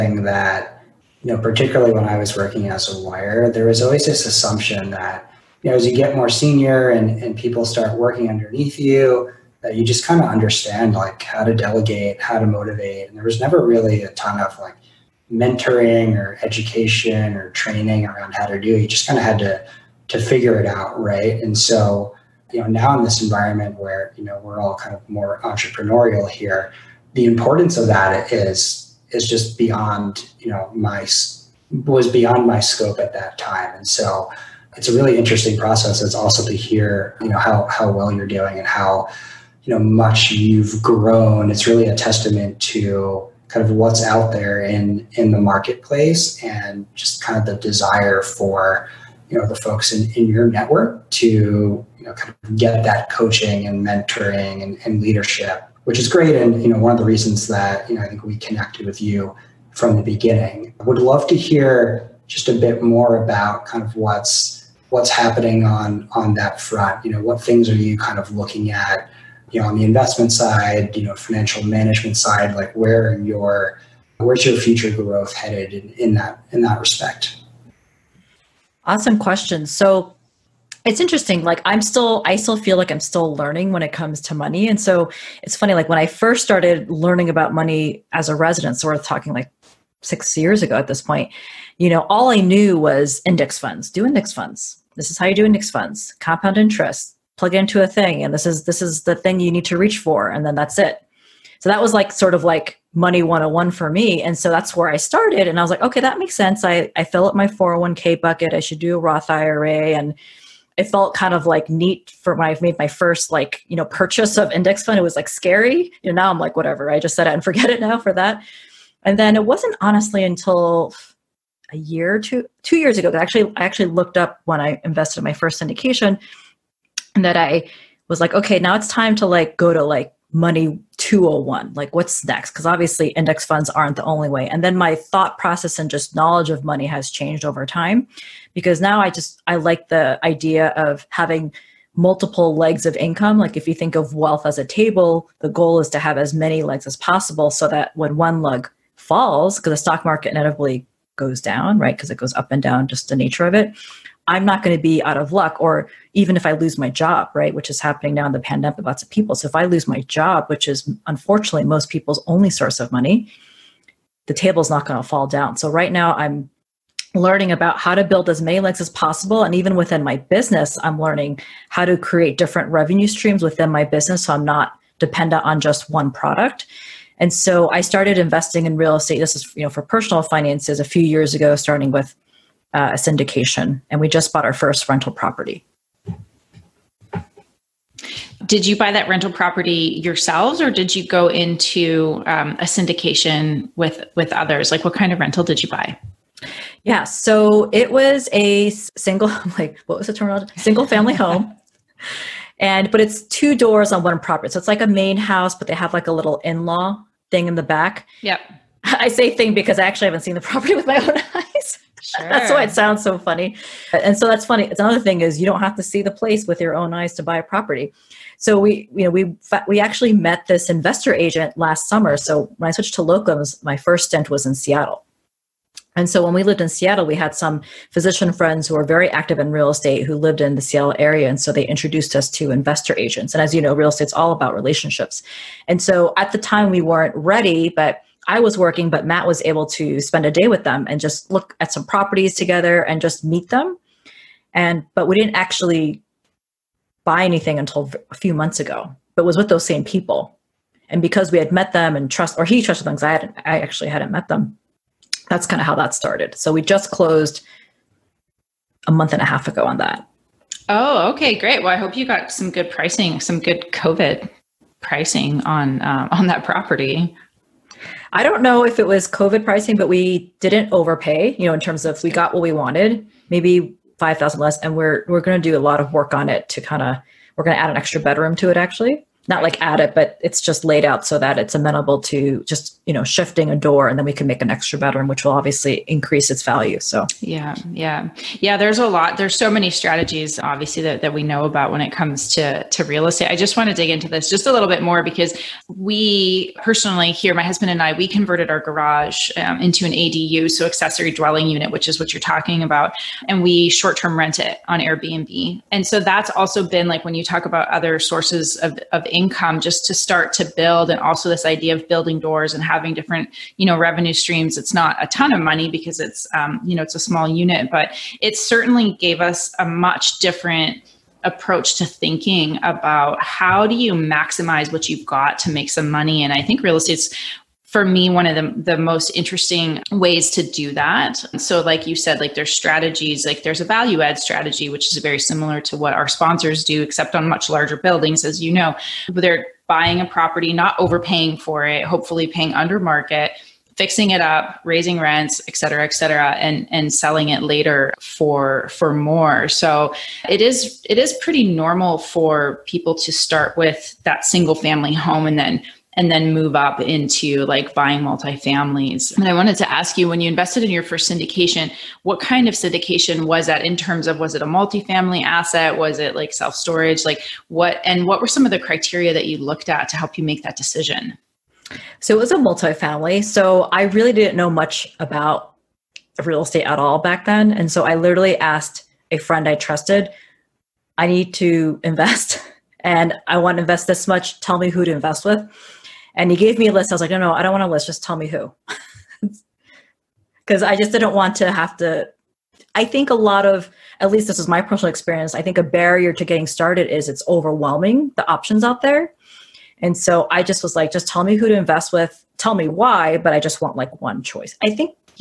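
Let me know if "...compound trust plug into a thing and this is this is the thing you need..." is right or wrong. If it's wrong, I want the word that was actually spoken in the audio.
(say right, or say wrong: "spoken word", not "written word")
wrong: "interest", not "trust".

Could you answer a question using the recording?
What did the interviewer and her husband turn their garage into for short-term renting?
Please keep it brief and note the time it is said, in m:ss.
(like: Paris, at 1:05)
an ADU, at 4:59.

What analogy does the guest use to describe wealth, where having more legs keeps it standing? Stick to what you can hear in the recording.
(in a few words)
a table.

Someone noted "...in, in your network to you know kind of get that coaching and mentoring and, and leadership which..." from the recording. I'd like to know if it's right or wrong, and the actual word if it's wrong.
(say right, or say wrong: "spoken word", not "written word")
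right.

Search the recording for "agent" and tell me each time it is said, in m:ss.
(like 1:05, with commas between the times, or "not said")
3:41, 3:52.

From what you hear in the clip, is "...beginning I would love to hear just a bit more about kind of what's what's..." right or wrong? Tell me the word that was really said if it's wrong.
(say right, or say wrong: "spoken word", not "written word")
right.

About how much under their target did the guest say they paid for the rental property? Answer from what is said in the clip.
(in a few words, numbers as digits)
$5,000.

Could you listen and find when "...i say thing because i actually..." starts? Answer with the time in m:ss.
3:28.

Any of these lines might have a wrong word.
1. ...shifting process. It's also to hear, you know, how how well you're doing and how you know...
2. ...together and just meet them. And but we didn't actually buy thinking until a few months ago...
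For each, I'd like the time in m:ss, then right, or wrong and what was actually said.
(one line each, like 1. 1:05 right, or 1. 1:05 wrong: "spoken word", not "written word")
1. 0:35 wrong: "interesting", not "shifting"
2. 4:02 wrong: "anything", not "thinking".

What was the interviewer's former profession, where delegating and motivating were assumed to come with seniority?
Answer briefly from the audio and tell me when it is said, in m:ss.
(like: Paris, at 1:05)
lawyer, at 0:02.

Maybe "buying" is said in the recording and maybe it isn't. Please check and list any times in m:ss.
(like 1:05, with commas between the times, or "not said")
5:39, 5:57.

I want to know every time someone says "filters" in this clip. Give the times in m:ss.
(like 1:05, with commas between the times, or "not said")
not said.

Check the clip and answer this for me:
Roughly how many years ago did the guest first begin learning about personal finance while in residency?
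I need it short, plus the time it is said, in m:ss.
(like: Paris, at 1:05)
6 years, at 1:30.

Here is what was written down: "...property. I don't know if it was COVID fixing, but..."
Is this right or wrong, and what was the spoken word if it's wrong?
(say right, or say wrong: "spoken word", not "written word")
wrong: "pricing", not "fixing".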